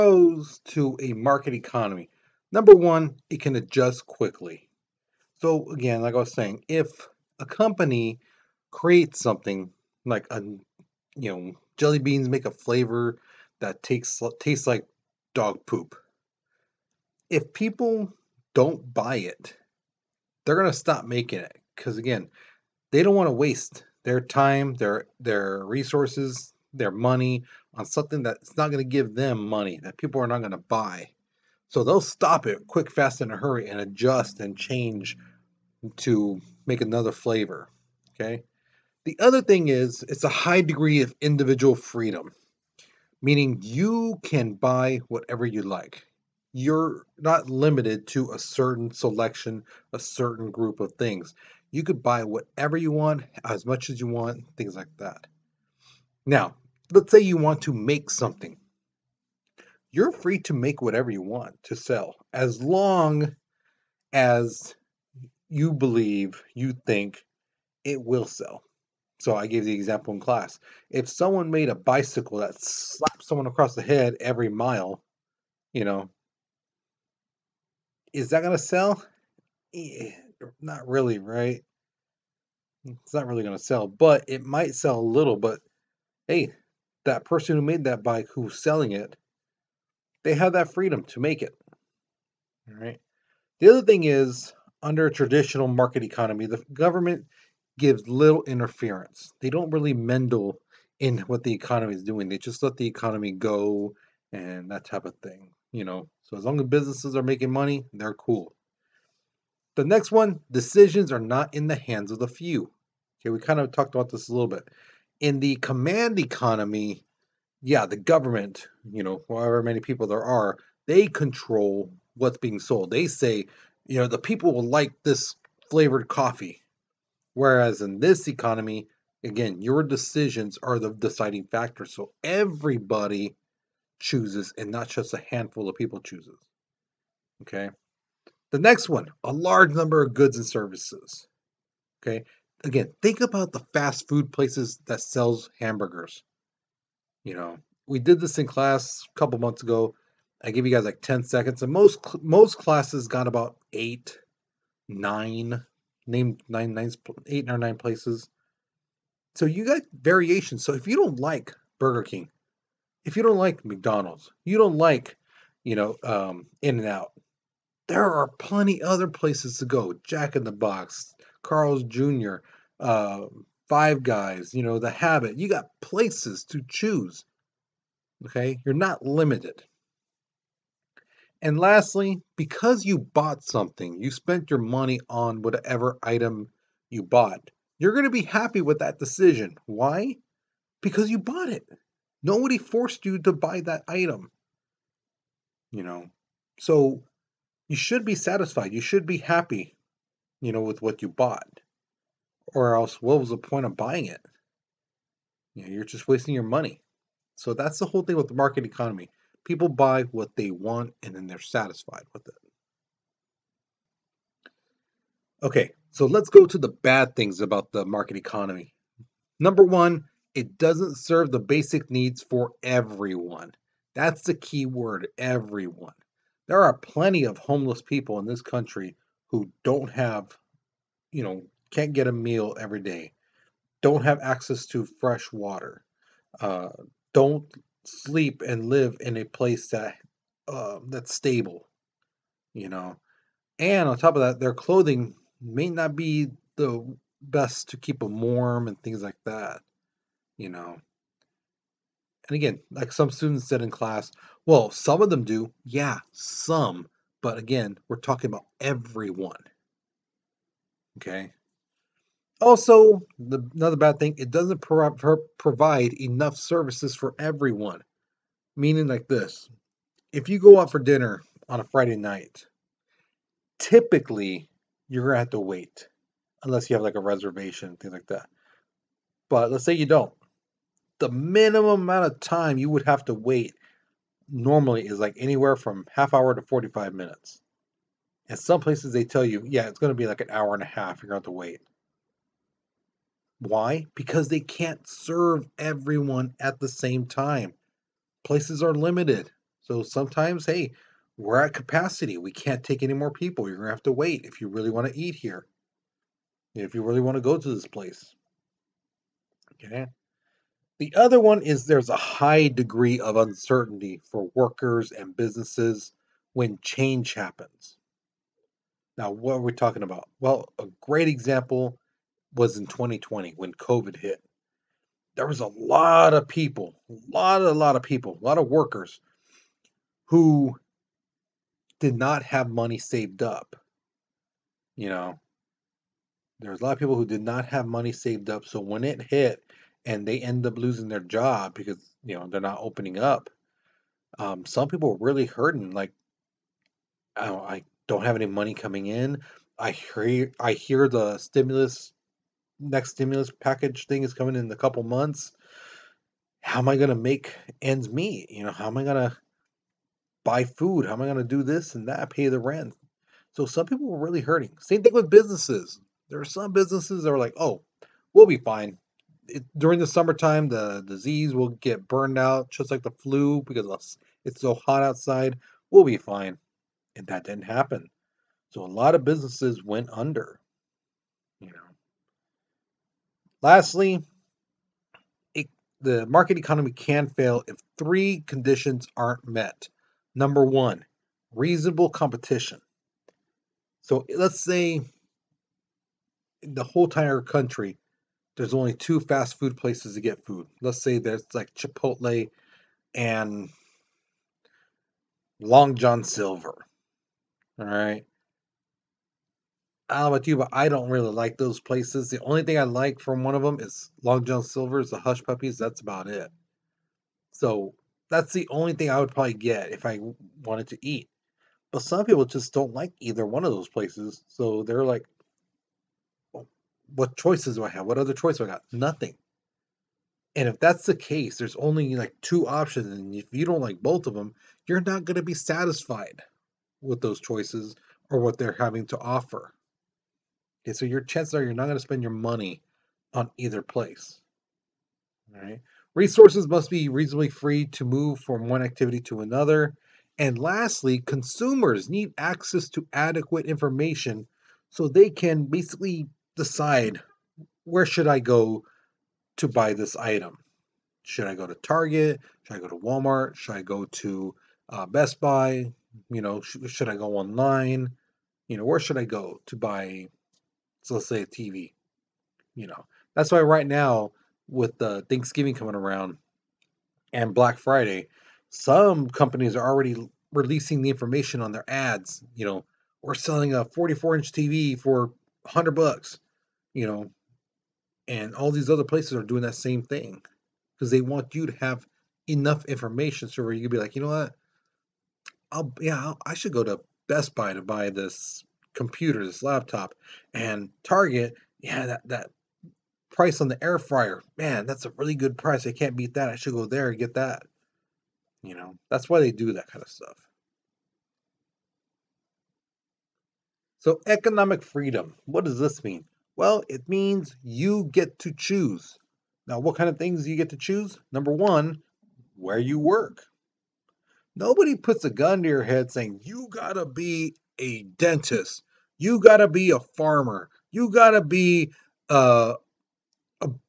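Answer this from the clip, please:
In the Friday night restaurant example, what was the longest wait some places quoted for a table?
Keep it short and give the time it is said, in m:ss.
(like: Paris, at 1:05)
an hour and a half, at 4:50.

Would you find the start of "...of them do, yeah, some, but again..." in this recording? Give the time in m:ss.
4:15.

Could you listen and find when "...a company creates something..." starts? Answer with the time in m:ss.
0:07.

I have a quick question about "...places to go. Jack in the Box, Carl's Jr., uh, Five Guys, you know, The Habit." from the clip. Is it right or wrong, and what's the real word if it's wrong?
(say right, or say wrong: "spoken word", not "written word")
right.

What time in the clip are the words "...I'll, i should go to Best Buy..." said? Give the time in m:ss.
8:15.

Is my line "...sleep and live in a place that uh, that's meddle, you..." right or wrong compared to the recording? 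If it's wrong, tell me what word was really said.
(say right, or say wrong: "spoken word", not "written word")
wrong: "stable", not "meddle".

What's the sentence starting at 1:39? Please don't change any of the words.
They don't really meddle in what the economy is doing.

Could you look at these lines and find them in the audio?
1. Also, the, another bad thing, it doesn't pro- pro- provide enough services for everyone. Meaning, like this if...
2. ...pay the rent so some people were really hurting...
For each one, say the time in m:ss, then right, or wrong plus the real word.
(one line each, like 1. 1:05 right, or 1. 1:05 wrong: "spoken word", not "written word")
1. 4:22 right
2. 6:02 right.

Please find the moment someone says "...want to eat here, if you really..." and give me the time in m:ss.
5:04.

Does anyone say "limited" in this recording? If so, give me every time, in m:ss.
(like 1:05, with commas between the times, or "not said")
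0:47, 2:59, 4:58.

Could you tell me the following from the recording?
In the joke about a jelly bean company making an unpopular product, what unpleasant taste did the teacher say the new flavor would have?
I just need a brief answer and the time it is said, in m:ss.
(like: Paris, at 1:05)
dog poop, at 0:15.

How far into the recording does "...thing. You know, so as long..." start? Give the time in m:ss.
1:45.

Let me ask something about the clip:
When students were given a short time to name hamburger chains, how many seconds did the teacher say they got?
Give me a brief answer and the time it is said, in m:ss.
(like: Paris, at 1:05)
10, at 2:31.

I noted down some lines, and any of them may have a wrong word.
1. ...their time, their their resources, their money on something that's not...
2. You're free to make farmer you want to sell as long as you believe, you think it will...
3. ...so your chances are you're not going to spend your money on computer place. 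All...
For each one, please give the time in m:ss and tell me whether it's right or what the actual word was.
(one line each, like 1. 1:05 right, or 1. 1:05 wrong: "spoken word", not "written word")
1. 0:24 right
2. 0:59 wrong: "whatever", not "farmer"
3. 7:20 wrong: "either", not "computer".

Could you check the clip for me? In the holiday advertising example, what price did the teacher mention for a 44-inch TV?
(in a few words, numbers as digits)
$100.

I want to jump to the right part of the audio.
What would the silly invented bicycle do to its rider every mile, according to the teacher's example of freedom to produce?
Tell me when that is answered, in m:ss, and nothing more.
1:12.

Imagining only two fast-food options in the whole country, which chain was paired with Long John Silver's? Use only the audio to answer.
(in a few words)
Chipotle.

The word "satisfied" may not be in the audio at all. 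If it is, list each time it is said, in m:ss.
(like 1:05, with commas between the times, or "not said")
3:18, 3:31, 7:15.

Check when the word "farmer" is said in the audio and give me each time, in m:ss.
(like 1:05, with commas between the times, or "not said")
8:49.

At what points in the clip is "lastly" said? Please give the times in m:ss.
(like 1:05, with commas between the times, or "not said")
3:01, 6:23, 7:30.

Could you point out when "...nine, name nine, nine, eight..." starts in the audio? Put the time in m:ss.
2:34.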